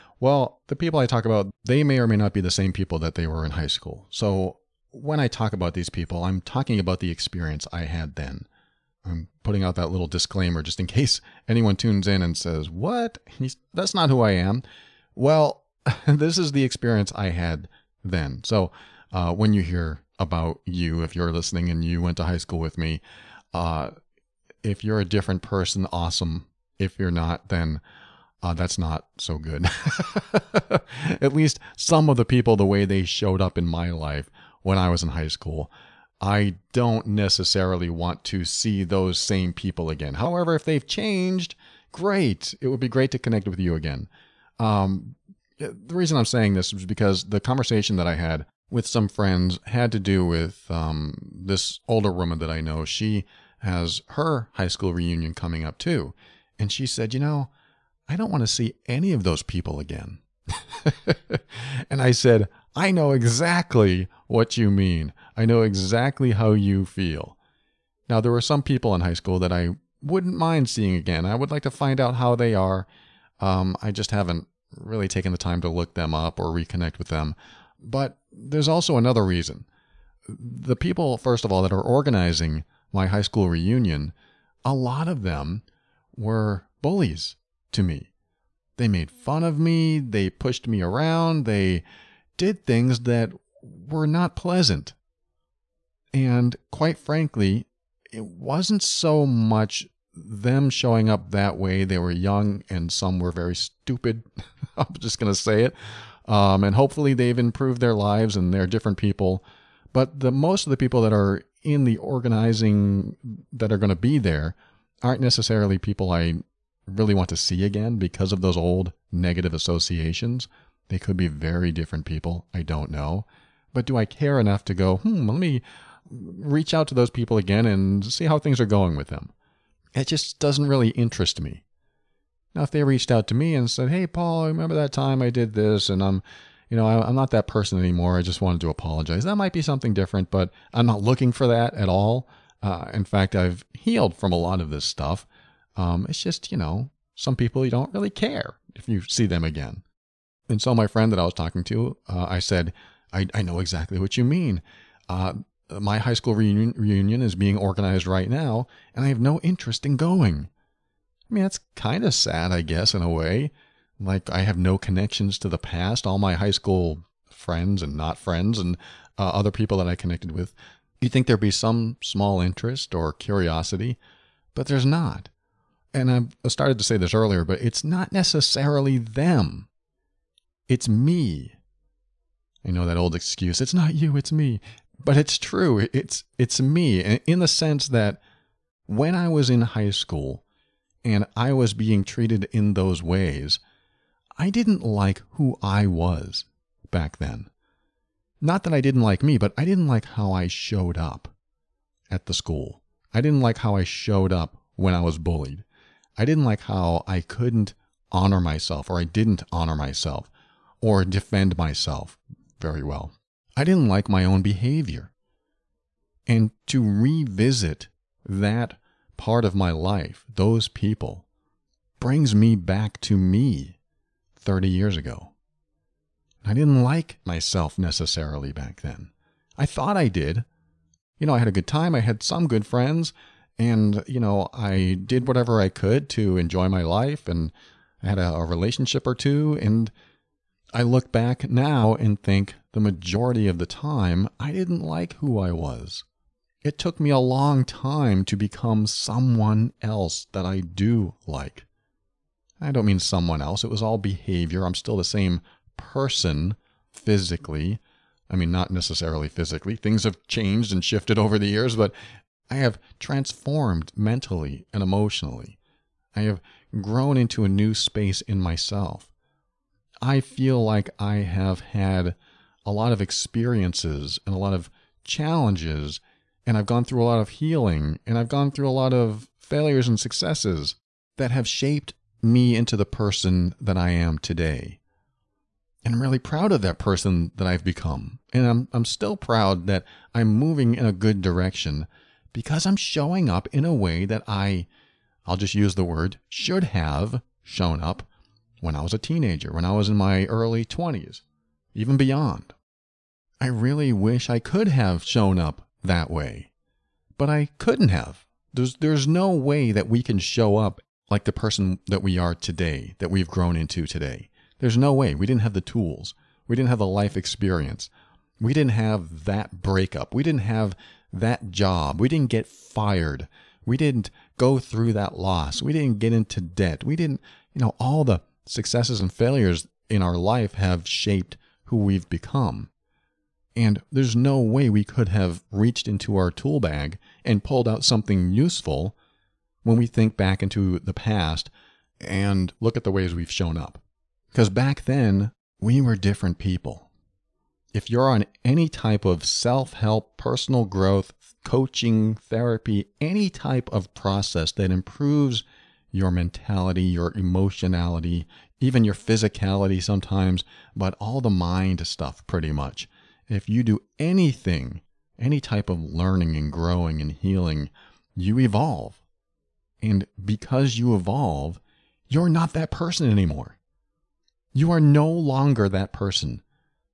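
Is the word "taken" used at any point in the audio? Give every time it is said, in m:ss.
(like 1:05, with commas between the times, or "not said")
1:15.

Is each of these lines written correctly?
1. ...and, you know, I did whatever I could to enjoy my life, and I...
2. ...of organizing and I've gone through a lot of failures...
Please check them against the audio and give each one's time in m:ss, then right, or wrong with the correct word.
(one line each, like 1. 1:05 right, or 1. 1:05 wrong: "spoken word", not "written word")
1. 3:53 right
2. 4:37 wrong: "healing", not "organizing".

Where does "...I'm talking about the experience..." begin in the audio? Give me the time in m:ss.
0:06.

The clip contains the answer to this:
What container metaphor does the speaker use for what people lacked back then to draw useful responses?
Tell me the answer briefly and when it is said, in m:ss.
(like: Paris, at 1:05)
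Tool bag, at 5:36.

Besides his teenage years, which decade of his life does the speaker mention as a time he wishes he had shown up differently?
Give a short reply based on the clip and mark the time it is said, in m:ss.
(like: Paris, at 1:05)
Early 20s, at 5:00.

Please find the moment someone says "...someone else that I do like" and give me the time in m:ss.
4:08.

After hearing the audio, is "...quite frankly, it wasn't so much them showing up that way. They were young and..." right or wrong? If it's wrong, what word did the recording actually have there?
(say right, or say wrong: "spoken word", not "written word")
right.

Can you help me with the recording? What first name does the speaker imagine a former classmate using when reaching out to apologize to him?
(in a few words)
Paul.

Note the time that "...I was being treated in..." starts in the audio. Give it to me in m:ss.
3:11.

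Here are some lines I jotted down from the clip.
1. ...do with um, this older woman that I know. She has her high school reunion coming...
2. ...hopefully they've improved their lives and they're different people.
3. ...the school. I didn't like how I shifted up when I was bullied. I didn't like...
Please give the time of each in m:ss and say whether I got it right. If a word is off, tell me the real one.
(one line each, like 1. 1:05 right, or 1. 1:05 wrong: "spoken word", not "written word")
1. 0:49 right
2. 1:46 right
3. 3:22 wrong: "showed", not "shifted".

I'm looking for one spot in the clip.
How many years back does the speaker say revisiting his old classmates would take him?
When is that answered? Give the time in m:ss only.
3:44.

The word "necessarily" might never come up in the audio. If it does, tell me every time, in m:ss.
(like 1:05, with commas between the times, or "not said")
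0:37, 1:55, 2:58, 3:47, 4:18.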